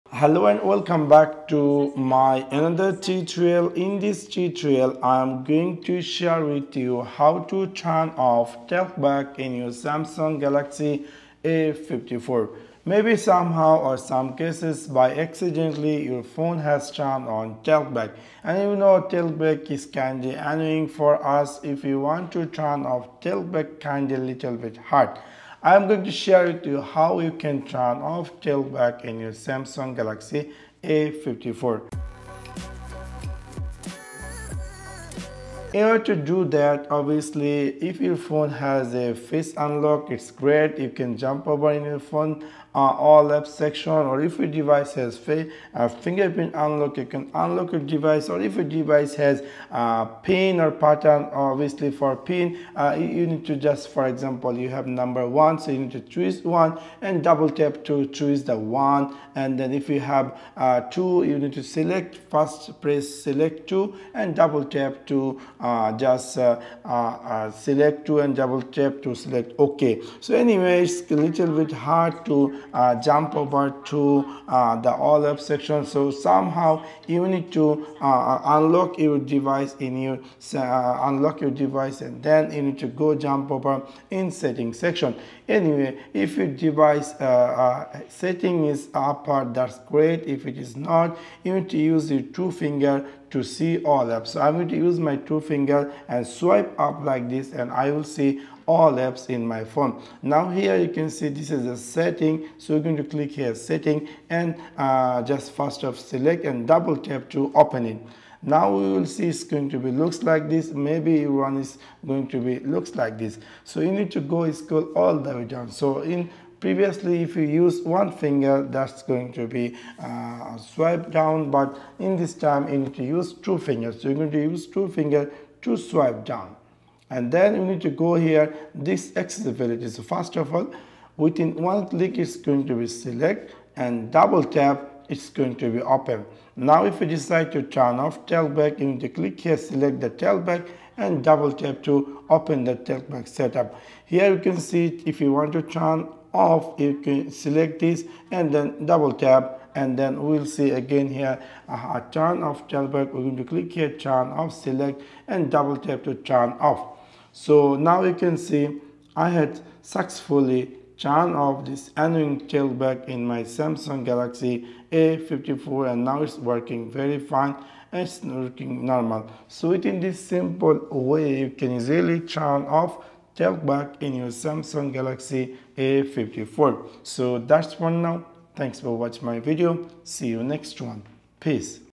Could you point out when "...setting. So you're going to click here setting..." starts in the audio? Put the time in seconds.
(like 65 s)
101 s.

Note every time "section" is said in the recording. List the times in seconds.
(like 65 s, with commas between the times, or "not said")
43 s, 75 s, 84 s.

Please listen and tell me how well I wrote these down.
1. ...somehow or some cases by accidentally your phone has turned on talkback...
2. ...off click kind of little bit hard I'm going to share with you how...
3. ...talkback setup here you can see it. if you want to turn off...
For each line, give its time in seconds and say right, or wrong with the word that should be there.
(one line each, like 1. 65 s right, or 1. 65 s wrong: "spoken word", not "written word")
1. 13 s right
2. 22 s wrong: "talkback", not "click"
3. 142 s right.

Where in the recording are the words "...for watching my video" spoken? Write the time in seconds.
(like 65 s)
178 s.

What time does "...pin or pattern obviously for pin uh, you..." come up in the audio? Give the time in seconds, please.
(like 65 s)
50 s.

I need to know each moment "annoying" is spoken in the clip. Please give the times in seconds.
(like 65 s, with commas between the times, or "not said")
20 s, 161 s.